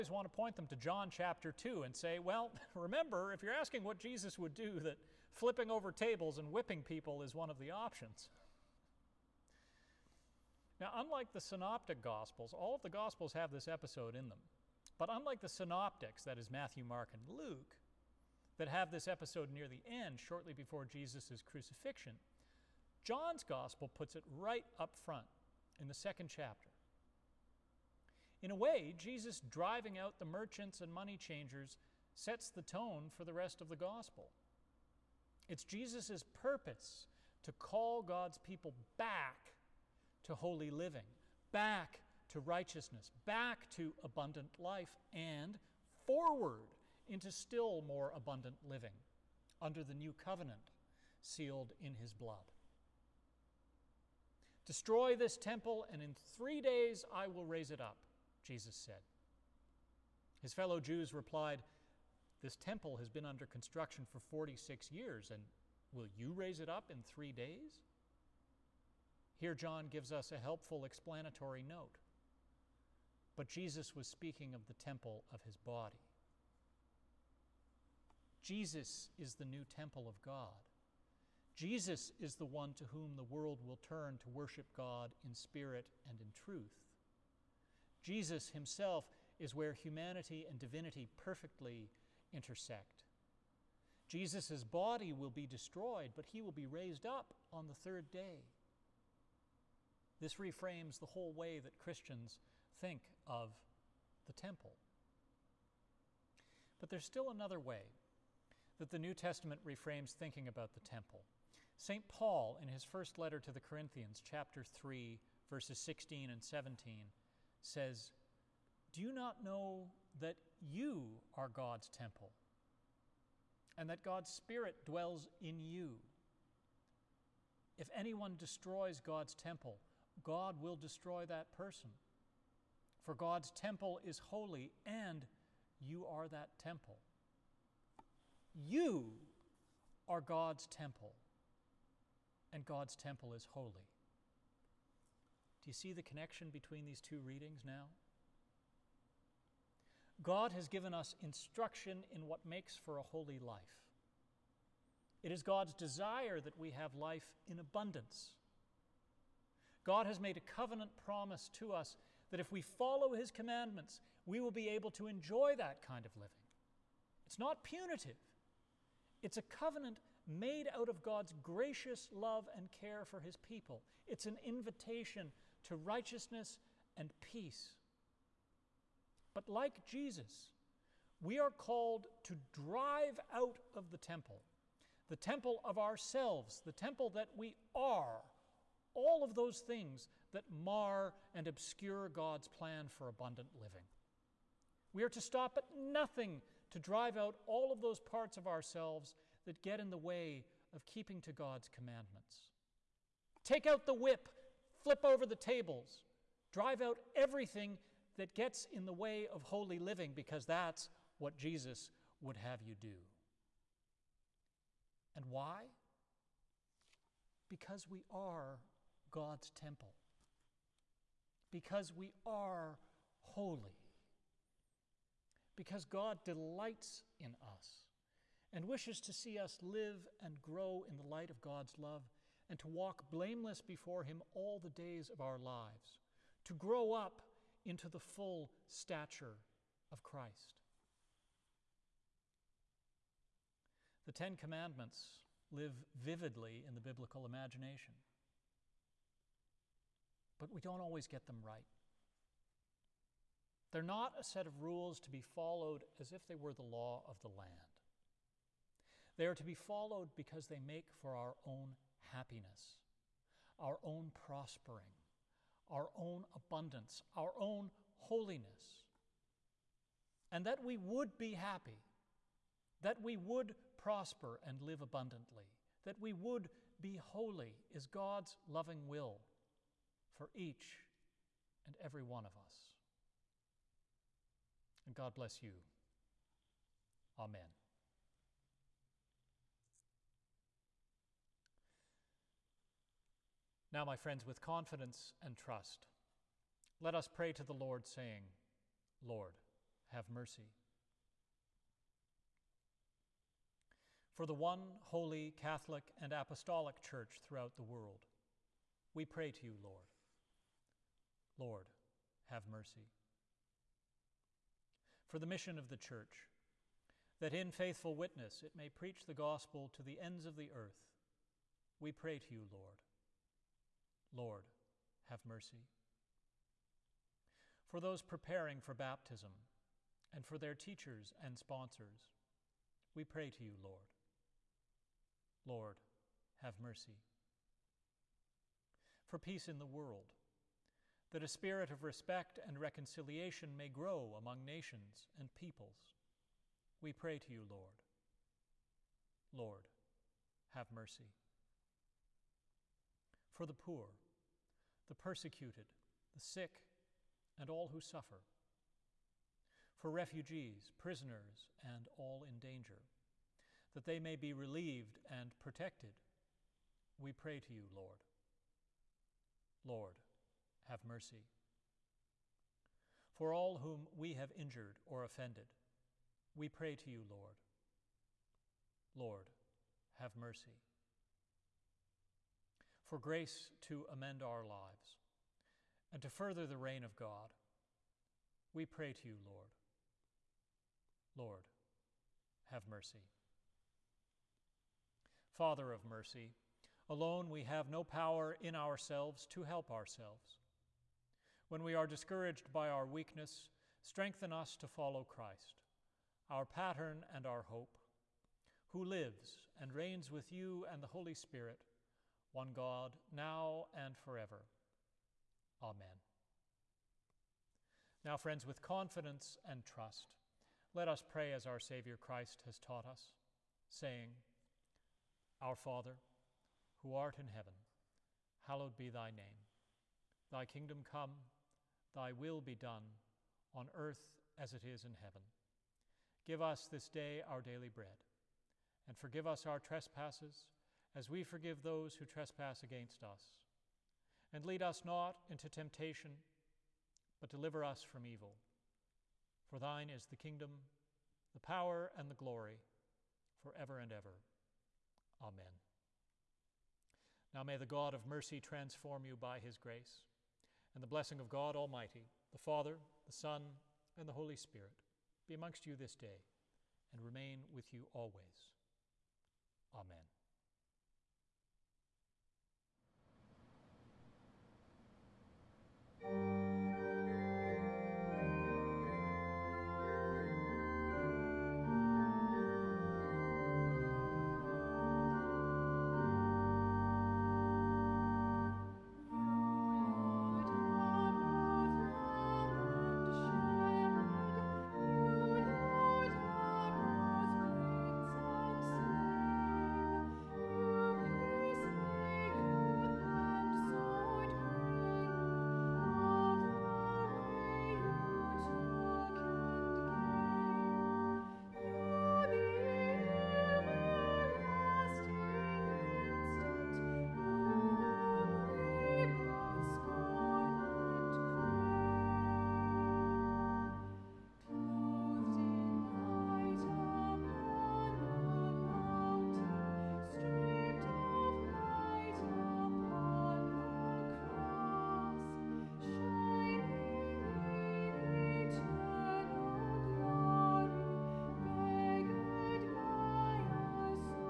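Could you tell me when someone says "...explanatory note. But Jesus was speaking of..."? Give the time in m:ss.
1:10.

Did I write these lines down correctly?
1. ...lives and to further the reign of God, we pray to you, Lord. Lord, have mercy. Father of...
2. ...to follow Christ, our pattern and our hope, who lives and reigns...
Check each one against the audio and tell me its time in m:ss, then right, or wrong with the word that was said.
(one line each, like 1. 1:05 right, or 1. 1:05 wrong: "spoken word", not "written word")
1. 6:24 right
2. 6:44 right.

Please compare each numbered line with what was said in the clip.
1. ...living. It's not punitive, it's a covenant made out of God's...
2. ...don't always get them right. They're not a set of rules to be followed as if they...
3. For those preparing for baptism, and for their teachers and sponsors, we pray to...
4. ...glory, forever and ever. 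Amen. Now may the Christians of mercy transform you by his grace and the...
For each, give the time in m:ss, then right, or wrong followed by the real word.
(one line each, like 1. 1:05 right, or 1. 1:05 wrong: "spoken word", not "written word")
1. 2:46 right
2. 4:10 right
3. 5:27 right
4. 7:32 wrong: "God", not "Christians".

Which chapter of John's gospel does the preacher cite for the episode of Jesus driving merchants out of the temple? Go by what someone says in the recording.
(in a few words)
Chapter 2.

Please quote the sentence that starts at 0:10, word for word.
Now, unlike the synoptic gospels, all of the gospels have this episode in them.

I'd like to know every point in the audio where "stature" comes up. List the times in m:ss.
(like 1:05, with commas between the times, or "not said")
3:58.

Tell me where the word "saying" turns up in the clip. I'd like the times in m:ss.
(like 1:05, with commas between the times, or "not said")
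4:57, 7:03.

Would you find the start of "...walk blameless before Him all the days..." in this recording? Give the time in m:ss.
3:52.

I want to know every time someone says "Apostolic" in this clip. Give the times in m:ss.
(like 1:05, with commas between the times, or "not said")
5:06.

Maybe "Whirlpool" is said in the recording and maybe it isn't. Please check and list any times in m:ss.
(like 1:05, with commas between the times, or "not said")
not said.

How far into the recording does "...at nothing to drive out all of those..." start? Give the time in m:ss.
3:15.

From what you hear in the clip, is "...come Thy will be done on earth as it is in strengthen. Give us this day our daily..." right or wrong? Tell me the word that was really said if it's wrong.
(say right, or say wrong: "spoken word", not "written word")
wrong: "heaven", not "strengthen".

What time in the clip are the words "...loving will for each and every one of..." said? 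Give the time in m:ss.
4:38.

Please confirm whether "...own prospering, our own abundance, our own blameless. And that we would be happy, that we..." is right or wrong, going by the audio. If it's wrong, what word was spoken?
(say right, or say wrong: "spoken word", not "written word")
wrong: "holiness", not "blameless".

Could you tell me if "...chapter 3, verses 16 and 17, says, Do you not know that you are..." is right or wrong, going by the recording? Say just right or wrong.
right.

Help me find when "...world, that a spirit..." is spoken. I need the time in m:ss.
5:39.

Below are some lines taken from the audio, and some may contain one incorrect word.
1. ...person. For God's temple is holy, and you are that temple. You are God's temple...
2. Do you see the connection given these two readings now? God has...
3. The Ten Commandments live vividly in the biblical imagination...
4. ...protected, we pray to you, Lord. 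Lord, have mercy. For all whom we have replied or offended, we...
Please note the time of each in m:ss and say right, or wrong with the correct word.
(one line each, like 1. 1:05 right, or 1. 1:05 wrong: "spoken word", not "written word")
1. 2:11 right
2. 2:25 wrong: "between", not "given"
3. 4:04 right
4. 6:05 wrong: "injured", not "replied".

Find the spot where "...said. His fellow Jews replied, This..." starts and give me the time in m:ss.
0:58.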